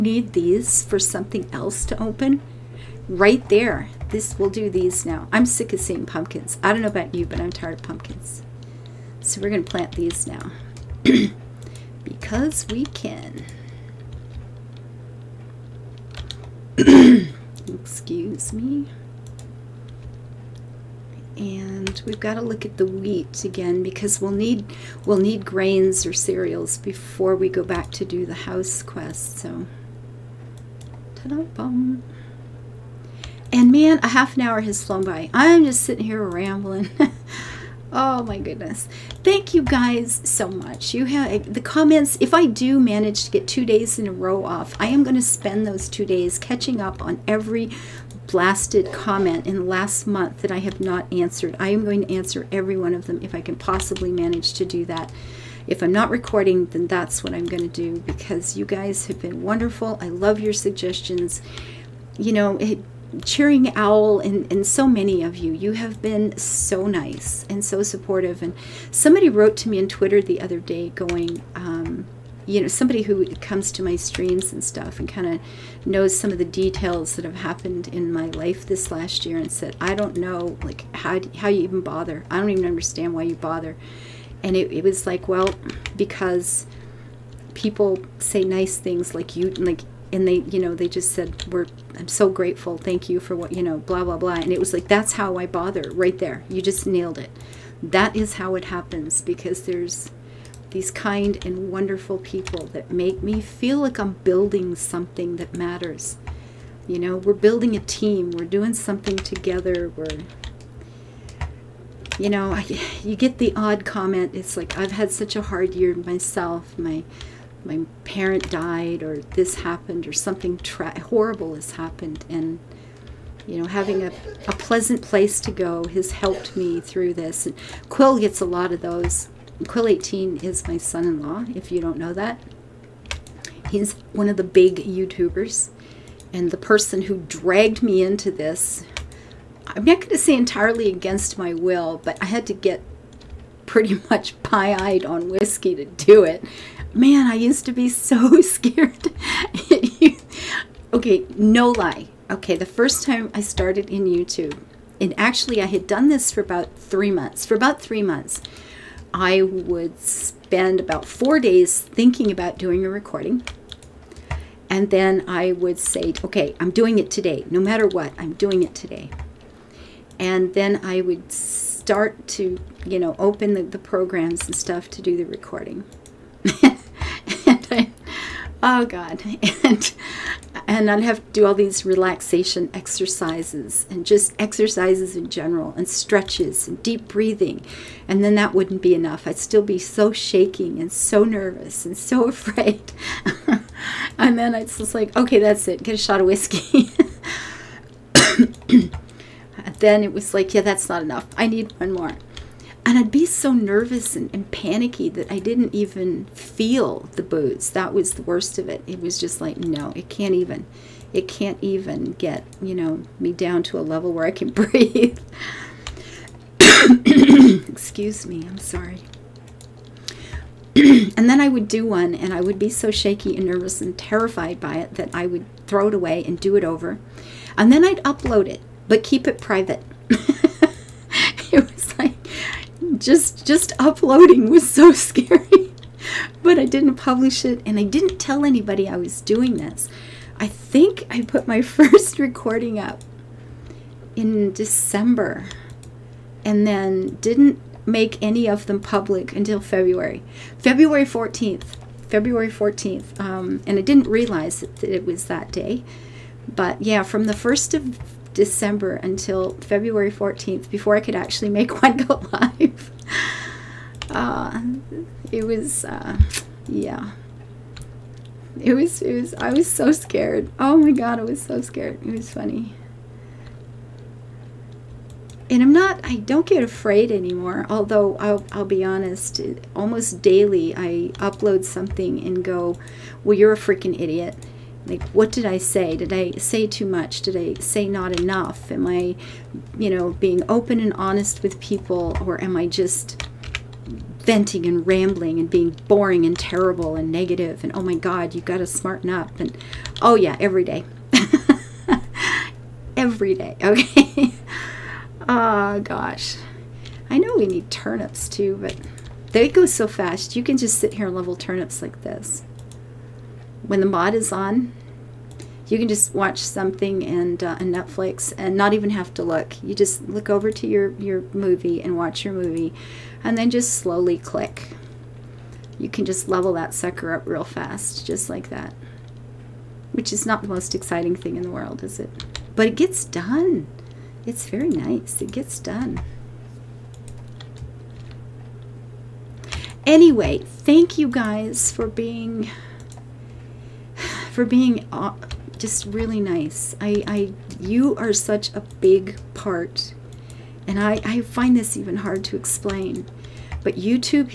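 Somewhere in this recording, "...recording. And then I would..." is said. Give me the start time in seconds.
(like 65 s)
162 s.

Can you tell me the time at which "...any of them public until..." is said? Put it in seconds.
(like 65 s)
248 s.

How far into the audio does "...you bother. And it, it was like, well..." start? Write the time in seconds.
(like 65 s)
83 s.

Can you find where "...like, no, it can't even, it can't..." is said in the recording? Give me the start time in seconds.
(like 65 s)
209 s.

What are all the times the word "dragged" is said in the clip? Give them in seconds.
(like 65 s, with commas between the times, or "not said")
137 s.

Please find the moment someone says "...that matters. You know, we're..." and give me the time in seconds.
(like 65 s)
105 s.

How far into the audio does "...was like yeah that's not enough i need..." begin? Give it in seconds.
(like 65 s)
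200 s.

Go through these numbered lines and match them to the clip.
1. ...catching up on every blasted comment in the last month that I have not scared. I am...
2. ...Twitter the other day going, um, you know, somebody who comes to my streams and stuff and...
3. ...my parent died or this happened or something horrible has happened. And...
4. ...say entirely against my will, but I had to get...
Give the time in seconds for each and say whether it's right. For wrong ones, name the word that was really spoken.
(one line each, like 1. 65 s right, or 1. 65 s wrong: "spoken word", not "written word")
1. 46 s wrong: "answered", not "scared"
2. 69 s right
3. 117 s right
4. 140 s right.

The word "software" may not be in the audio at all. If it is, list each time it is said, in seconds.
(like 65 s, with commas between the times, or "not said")
not said.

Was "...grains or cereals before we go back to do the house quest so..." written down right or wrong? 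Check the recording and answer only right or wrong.
right.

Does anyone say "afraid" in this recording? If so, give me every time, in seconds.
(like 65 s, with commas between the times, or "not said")
192 s, 276 s.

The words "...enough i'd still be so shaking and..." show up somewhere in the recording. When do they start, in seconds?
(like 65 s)
188 s.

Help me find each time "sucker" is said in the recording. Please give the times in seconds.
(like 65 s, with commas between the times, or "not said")
326 s.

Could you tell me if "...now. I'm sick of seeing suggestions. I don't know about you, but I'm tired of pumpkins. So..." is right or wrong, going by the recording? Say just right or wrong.
wrong.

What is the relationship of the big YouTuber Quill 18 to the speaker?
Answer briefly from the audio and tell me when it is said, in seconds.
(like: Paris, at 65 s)
Son-in-law, at 130 s.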